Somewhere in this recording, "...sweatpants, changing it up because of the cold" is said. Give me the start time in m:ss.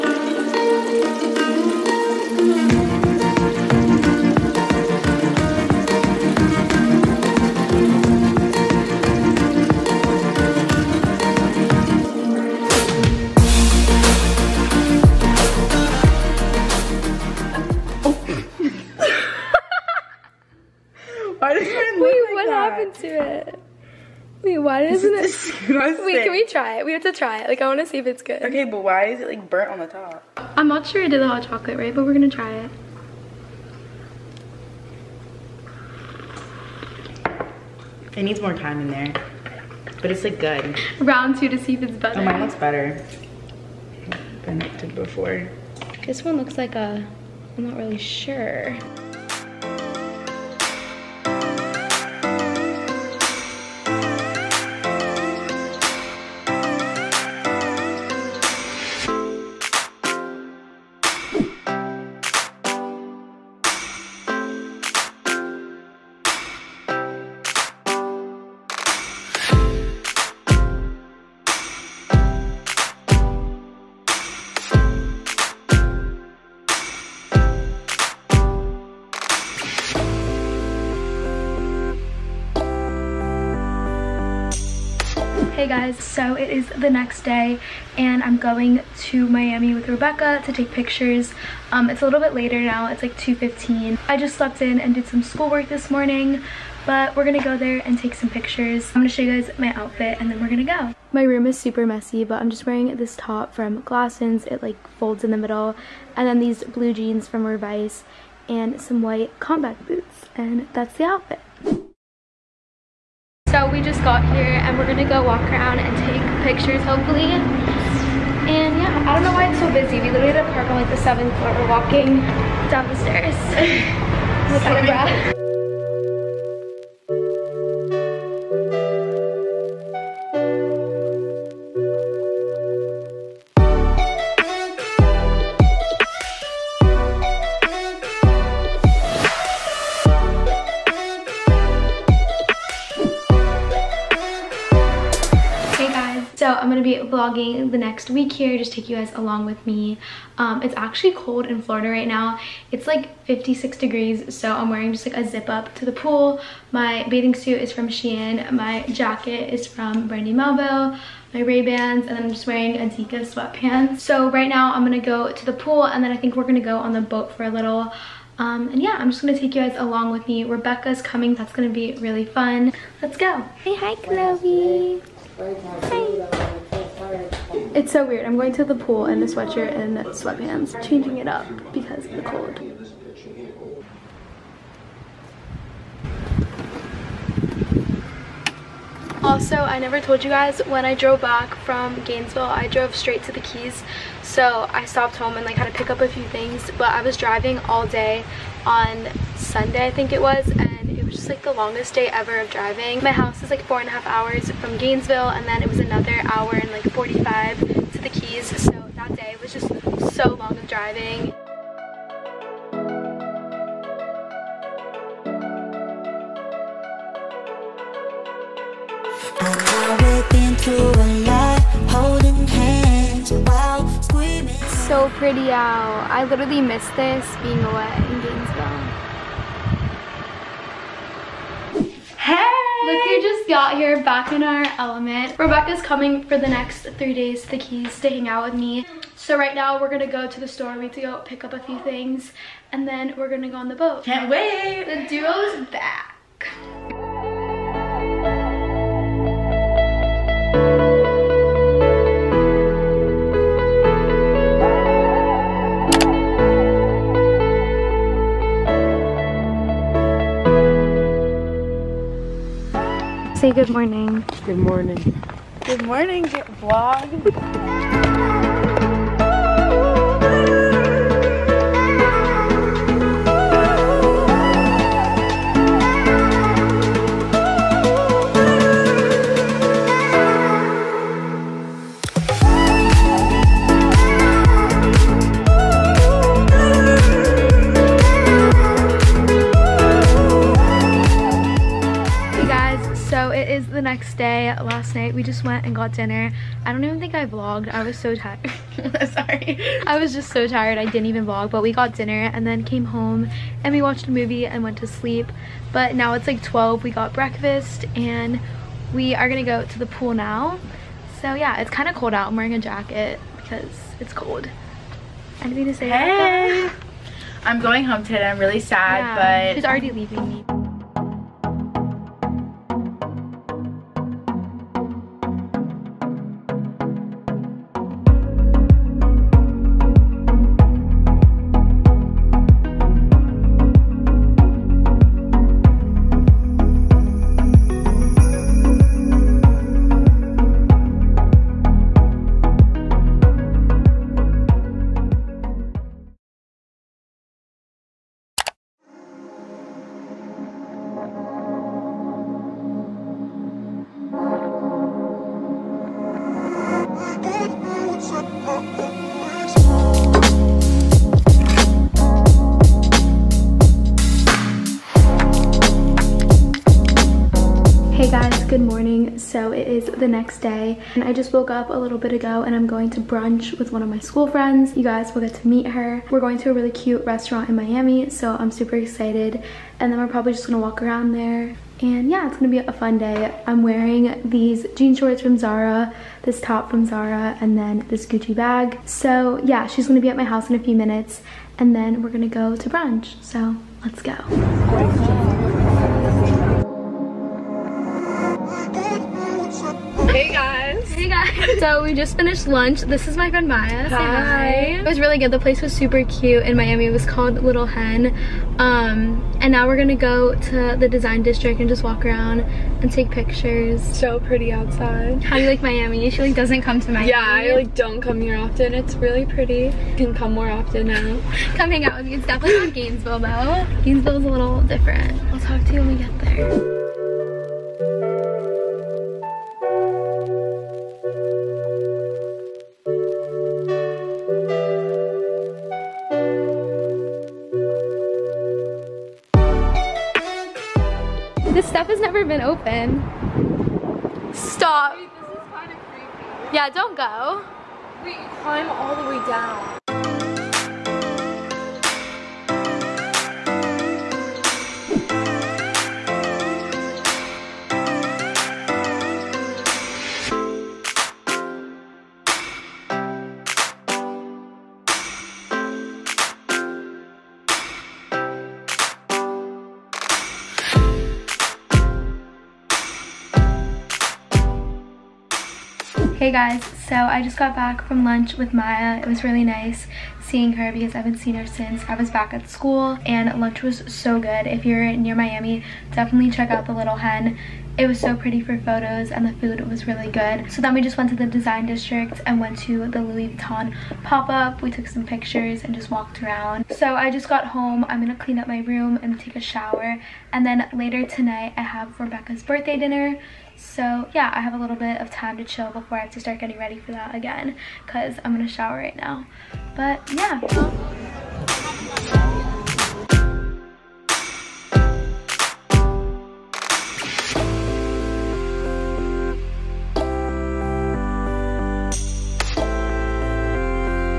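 2:59.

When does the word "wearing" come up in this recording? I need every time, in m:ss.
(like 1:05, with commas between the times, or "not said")
1:42, 2:34, 2:42, 5:12, 6:23.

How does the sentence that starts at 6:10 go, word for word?
And I just woke up a little bit ago and I'm going to brunch with one of my school friends.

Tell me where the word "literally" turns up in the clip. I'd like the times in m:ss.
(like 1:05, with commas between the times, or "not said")
2:00, 3:46.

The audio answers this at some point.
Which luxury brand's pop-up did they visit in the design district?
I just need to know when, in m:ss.
8:13.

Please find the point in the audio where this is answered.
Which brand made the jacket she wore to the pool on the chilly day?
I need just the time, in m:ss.
2:40.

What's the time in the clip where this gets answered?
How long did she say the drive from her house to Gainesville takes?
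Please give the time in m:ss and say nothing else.
3:23.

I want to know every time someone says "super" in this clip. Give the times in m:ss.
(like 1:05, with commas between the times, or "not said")
1:41, 6:18, 6:45.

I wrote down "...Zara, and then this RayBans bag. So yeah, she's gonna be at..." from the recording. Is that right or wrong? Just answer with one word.
wrong.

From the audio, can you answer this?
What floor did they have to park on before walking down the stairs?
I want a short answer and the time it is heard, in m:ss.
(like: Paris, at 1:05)
Seventh floor, at 2:01.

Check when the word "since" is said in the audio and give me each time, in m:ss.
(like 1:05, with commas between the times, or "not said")
8:01.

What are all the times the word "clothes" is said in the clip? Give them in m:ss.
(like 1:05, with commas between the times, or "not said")
not said.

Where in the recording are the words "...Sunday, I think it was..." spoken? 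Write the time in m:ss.
3:19.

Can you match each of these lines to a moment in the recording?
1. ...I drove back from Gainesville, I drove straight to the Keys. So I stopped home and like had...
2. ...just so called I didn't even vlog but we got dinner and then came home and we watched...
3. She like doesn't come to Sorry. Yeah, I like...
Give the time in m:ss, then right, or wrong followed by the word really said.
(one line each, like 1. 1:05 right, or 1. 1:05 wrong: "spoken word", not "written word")
1. 3:10 right
2. 5:00 wrong: "tired", not "called"
3. 6:56 wrong: "Miami", not "Sorry".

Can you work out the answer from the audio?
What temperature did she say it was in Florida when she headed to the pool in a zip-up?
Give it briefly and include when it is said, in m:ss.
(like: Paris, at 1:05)
56 degrees, at 2:33.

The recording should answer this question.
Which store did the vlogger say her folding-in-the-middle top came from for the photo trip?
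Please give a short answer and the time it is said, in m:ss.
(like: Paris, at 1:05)
Glassons, at 1:43.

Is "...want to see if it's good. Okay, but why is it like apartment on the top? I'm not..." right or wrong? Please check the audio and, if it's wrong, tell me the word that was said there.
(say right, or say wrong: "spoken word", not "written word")
wrong: "burnt", not "apartment".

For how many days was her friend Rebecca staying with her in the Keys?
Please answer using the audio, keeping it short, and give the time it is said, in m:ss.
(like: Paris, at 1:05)
Three days, at 3:56.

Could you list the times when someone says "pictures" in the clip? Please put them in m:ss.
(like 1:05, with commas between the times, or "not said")
1:30, 1:38, 1:56, 6:53, 8:15.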